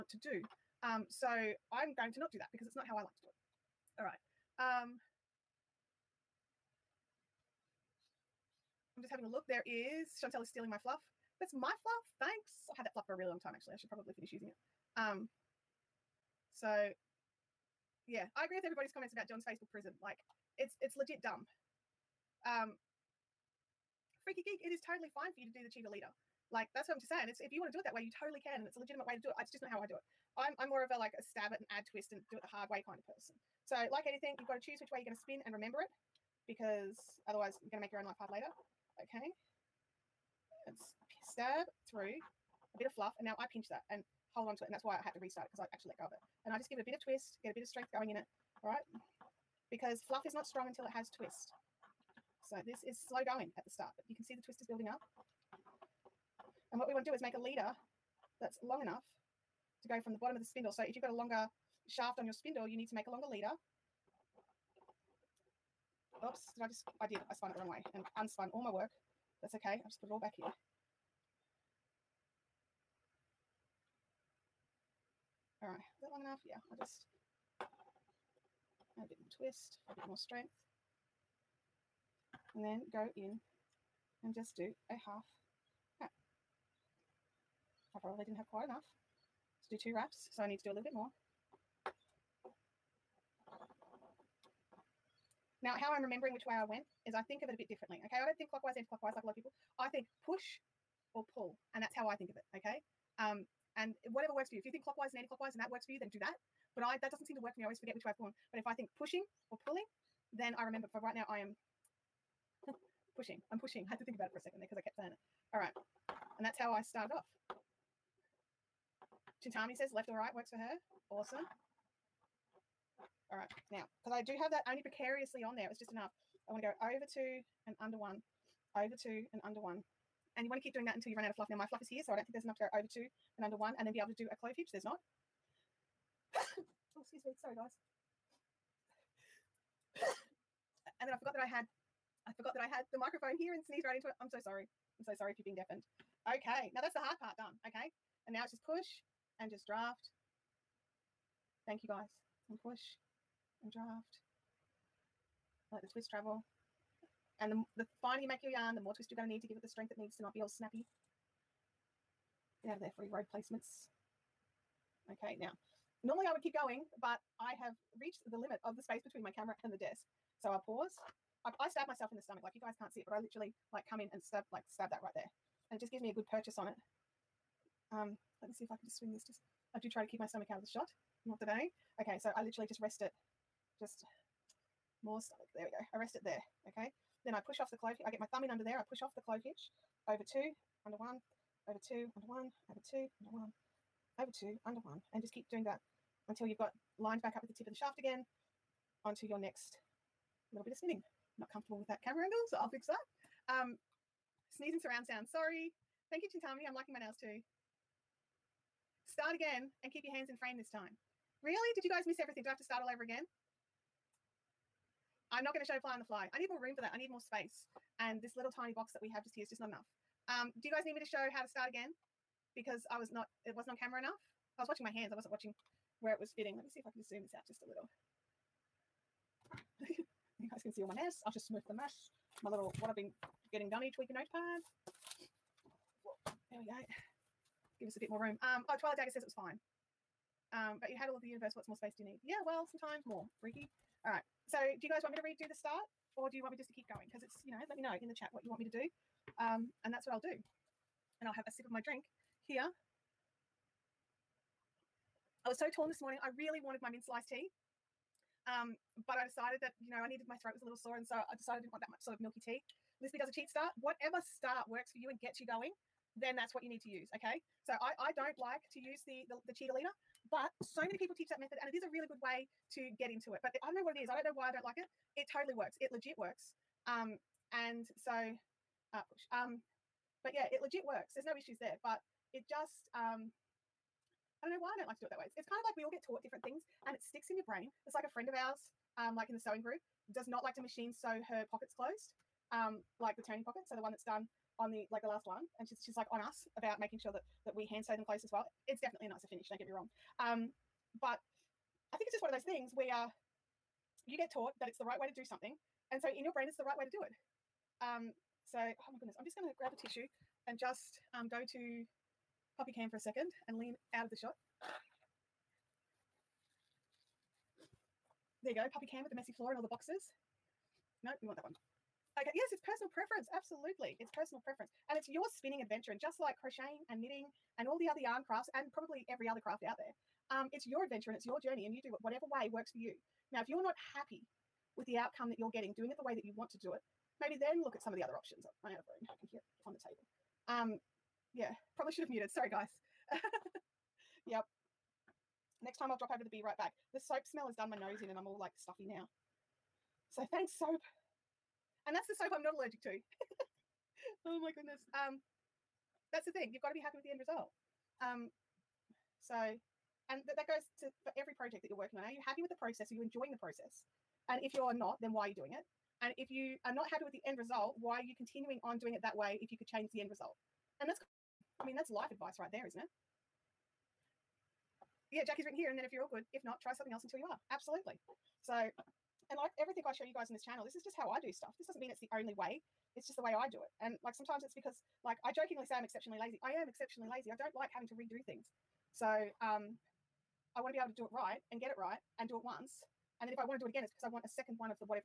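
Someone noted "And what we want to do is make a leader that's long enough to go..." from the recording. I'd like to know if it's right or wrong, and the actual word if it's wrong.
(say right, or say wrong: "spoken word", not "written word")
right.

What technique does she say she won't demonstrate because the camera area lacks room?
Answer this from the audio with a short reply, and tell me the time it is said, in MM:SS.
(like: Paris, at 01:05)
ply on the fly, at 03:35.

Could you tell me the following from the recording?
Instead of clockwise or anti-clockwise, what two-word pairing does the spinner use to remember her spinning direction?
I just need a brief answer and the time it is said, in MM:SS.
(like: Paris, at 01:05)
push or pull, at 01:40.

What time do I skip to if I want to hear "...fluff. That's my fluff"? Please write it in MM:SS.
00:10.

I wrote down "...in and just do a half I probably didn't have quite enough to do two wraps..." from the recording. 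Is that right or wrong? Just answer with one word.
right.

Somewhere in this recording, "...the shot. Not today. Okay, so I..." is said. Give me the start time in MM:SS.
03:00.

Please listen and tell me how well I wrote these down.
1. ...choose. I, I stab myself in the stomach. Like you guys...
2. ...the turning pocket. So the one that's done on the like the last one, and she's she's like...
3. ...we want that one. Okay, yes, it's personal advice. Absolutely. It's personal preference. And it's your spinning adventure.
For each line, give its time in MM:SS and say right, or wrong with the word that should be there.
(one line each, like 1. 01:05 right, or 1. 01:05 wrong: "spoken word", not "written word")
1. 02:50 wrong: "pause", not "choose"
2. 04:53 right
3. 05:21 wrong: "preference", not "advice".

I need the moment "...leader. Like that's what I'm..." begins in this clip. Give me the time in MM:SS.
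00:25.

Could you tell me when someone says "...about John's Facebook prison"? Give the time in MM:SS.
00:19.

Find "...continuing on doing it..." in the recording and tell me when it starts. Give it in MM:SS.
06:08.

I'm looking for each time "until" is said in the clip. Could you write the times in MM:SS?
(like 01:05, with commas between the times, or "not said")
00:50, 02:10, 03:16, 06:17.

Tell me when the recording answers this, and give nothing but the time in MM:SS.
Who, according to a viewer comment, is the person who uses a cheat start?
04:23.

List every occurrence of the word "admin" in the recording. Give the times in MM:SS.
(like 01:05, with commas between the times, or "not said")
not said.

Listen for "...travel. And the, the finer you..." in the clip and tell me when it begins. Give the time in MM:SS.
02:36.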